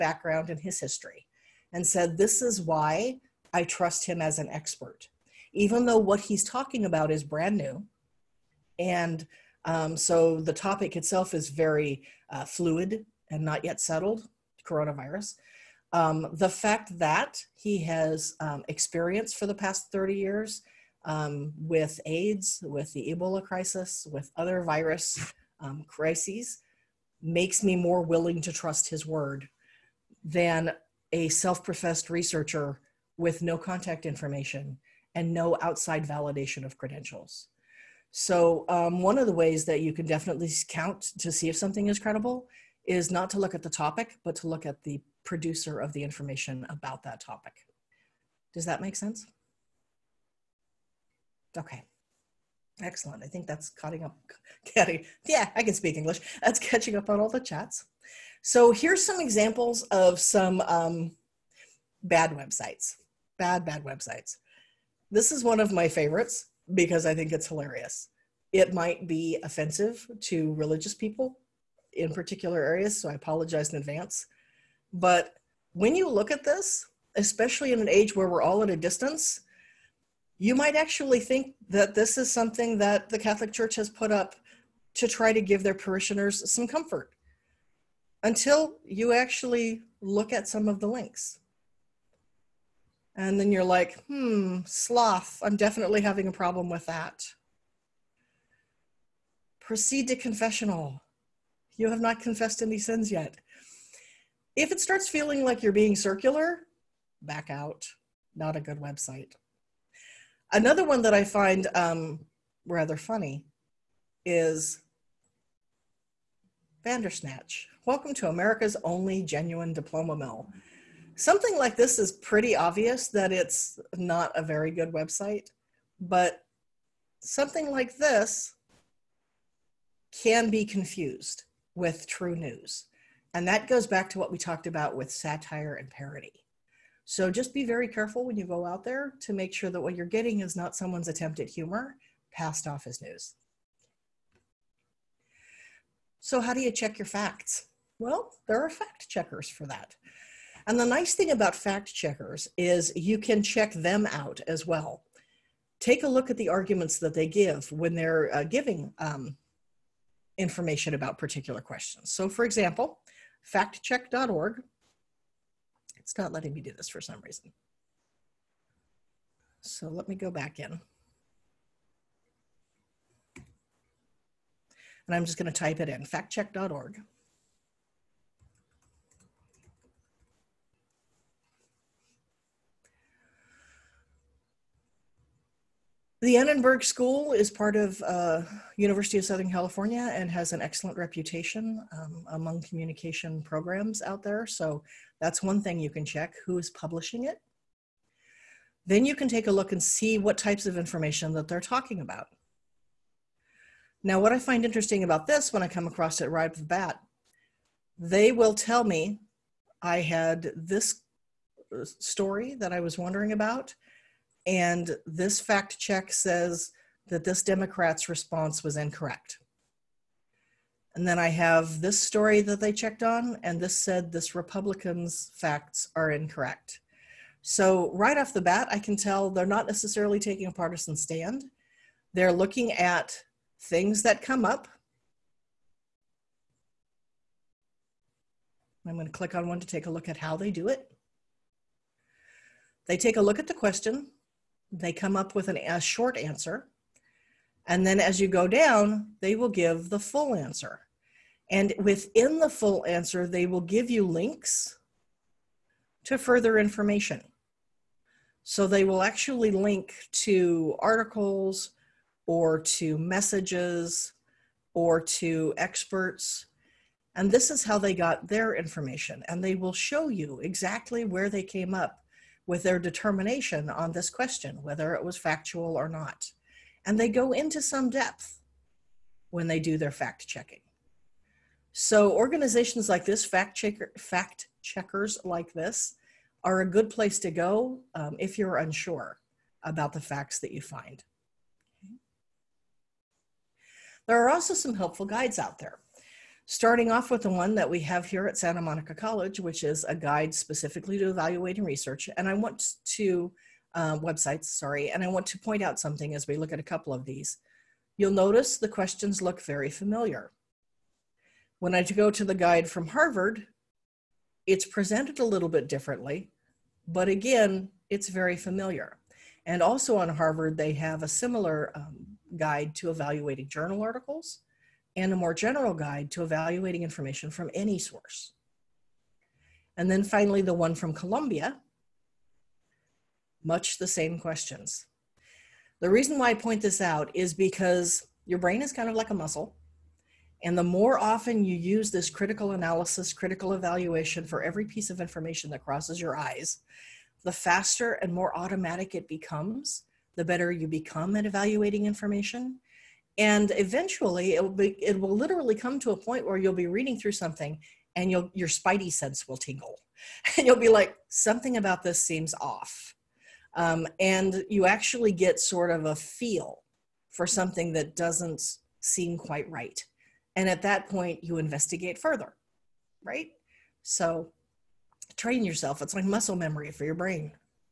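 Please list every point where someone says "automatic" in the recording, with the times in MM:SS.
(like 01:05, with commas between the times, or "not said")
05:48.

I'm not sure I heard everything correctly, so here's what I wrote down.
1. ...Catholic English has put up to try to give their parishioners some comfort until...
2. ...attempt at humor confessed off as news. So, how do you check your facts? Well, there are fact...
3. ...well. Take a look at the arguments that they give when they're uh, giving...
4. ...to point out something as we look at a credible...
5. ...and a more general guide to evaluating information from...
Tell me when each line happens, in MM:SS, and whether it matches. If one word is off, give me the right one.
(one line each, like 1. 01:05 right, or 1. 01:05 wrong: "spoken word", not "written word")
1. 01:23 wrong: "Church", not "English"
2. 02:21 wrong: "passed", not "confessed"
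3. 02:34 right
4. 05:05 wrong: "couple", not "credible"
5. 05:24 right.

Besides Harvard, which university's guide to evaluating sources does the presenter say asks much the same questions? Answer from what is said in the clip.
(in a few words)
Columbia.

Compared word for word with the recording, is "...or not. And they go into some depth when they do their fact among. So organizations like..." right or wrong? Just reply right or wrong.
wrong.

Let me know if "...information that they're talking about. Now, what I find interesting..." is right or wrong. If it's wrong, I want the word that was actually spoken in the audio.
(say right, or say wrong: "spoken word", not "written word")
right.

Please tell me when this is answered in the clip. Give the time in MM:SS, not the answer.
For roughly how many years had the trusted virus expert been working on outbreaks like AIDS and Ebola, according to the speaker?
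00:19.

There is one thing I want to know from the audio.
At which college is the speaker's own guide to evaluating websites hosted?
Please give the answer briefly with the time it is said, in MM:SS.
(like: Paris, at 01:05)
Santa Monica College, at 04:58.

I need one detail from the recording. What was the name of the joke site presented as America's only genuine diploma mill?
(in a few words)
Vandersnatch.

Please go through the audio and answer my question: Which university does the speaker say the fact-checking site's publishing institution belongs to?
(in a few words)
University of Southern California.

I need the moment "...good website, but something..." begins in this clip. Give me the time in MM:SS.
02:04.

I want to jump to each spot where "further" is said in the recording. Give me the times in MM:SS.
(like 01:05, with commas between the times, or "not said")
04:16, 06:11.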